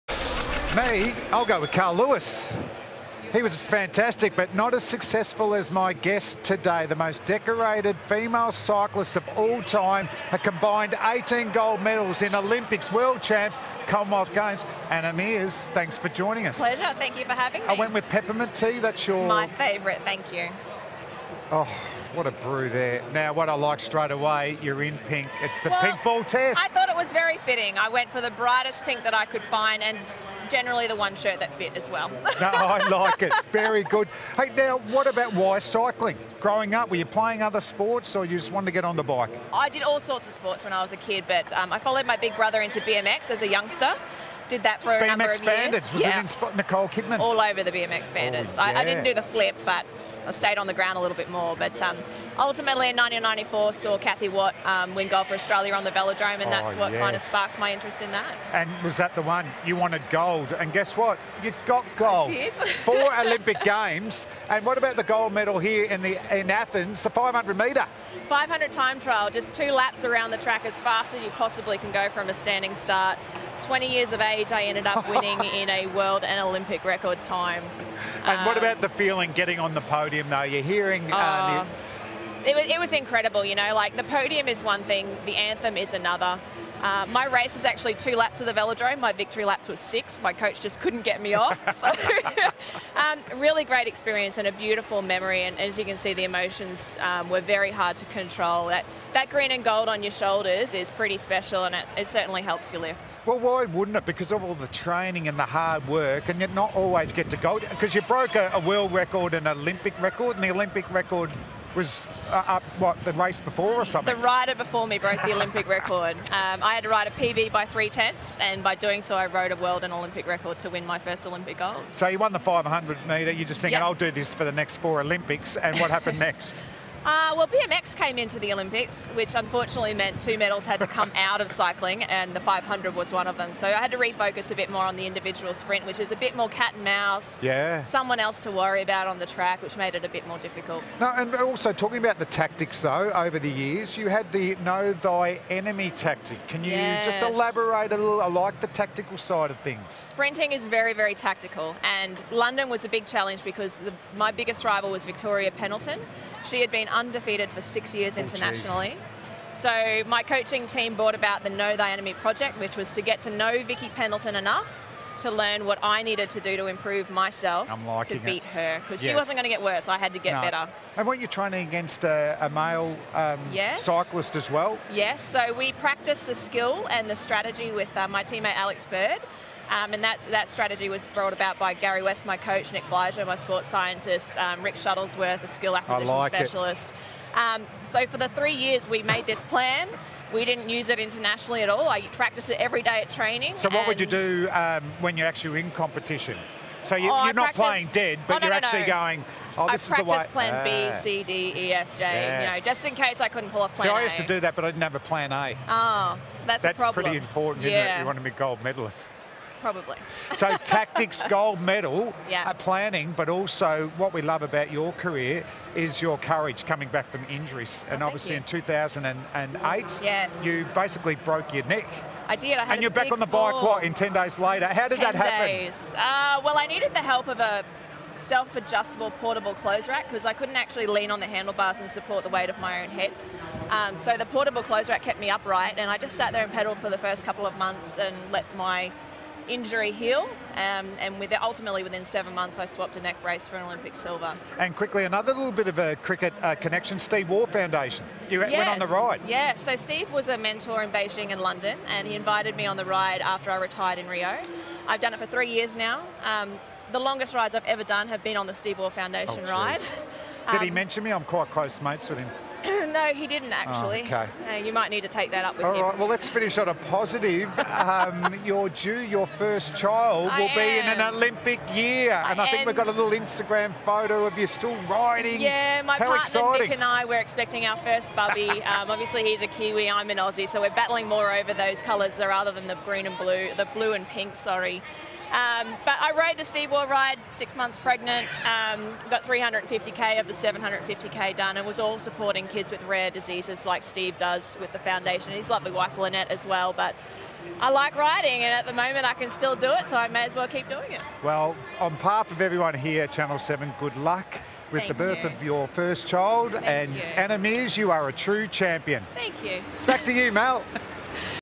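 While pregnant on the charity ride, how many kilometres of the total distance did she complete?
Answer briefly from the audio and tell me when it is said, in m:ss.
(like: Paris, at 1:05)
350k, at 4:49.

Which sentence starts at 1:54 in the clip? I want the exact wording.
The rider before me broke the Olympic record.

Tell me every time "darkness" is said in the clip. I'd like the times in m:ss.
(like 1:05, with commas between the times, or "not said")
not said.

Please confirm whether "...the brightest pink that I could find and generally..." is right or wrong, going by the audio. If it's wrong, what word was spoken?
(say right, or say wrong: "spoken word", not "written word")
right.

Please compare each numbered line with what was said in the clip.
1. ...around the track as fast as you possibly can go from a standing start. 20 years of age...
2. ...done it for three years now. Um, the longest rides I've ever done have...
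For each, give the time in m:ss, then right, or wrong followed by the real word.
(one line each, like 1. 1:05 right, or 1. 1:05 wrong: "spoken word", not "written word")
1. 1:10 right
2. 4:15 right.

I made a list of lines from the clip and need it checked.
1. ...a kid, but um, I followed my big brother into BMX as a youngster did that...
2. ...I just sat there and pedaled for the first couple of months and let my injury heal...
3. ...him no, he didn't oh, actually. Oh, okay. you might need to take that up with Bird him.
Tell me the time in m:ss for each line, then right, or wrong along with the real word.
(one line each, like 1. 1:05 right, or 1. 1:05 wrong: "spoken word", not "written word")
1. 0:40 right
2. 3:55 right
3. 4:22 wrong: "All", not "Bird".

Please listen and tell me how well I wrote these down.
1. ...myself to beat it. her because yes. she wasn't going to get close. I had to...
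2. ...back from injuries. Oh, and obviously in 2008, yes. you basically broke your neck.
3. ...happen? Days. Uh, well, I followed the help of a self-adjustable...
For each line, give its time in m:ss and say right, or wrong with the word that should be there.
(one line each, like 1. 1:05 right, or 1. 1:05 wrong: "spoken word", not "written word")
1. 2:47 wrong: "worse", not "close"
2. 3:36 right
3. 3:45 wrong: "needed", not "followed".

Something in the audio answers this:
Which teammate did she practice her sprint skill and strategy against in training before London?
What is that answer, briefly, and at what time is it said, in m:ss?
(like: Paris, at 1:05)
Alex Bird, at 2:58.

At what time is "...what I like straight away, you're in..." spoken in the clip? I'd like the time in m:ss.
0:23.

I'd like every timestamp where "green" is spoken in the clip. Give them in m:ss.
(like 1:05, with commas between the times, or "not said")
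1:39, 4:42.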